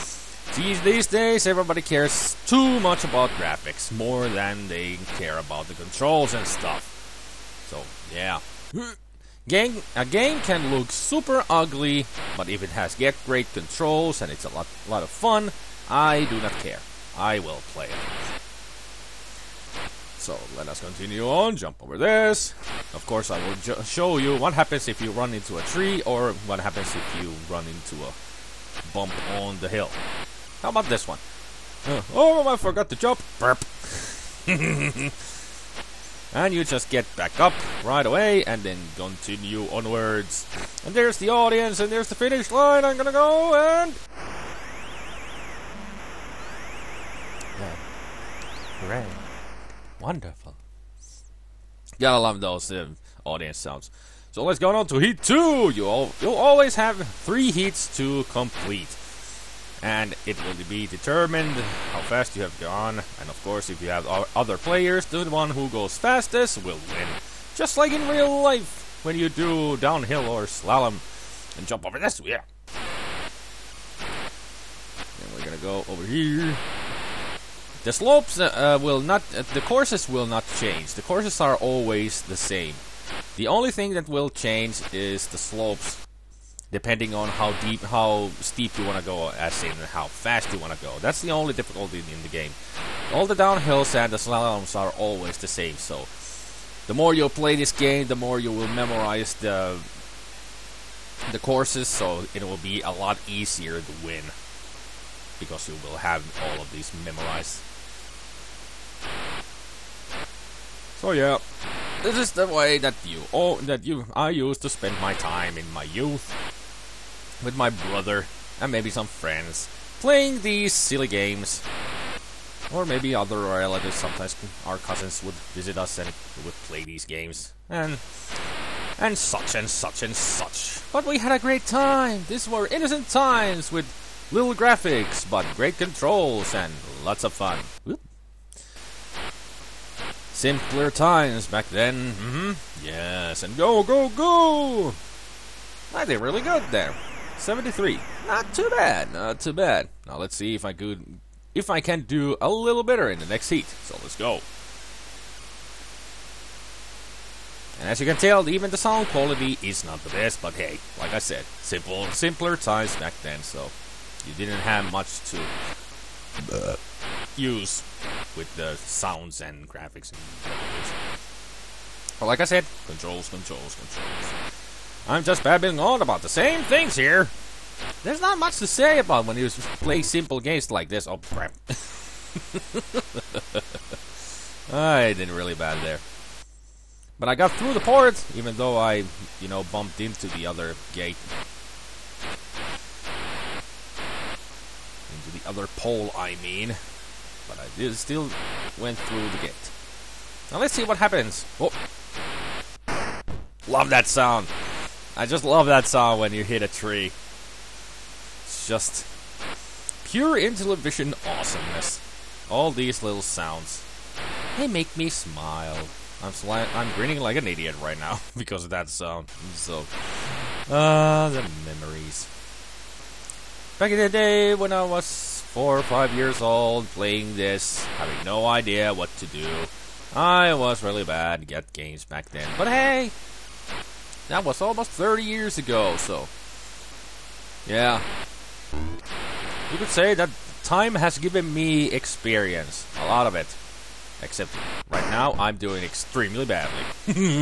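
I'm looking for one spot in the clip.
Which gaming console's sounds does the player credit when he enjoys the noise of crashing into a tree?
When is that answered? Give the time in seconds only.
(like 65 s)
210 s.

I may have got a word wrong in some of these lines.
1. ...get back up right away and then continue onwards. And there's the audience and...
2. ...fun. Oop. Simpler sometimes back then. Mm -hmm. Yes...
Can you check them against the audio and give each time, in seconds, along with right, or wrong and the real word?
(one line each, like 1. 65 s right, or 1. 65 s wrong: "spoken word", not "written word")
1. 36 s right
2. 137 s wrong: "times", not "sometimes".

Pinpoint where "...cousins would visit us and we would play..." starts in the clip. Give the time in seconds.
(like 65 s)
124 s.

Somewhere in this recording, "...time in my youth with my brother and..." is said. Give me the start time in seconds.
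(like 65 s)
115 s.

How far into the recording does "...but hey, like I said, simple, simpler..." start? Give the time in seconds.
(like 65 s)
160 s.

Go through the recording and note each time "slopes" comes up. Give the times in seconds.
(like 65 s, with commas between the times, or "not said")
77 s, 85 s.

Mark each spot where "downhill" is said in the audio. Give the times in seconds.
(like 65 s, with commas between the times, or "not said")
69 s, 93 s.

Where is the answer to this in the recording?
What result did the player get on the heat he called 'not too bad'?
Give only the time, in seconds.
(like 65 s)
147 s.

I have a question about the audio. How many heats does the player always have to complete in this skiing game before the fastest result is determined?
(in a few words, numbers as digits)
3.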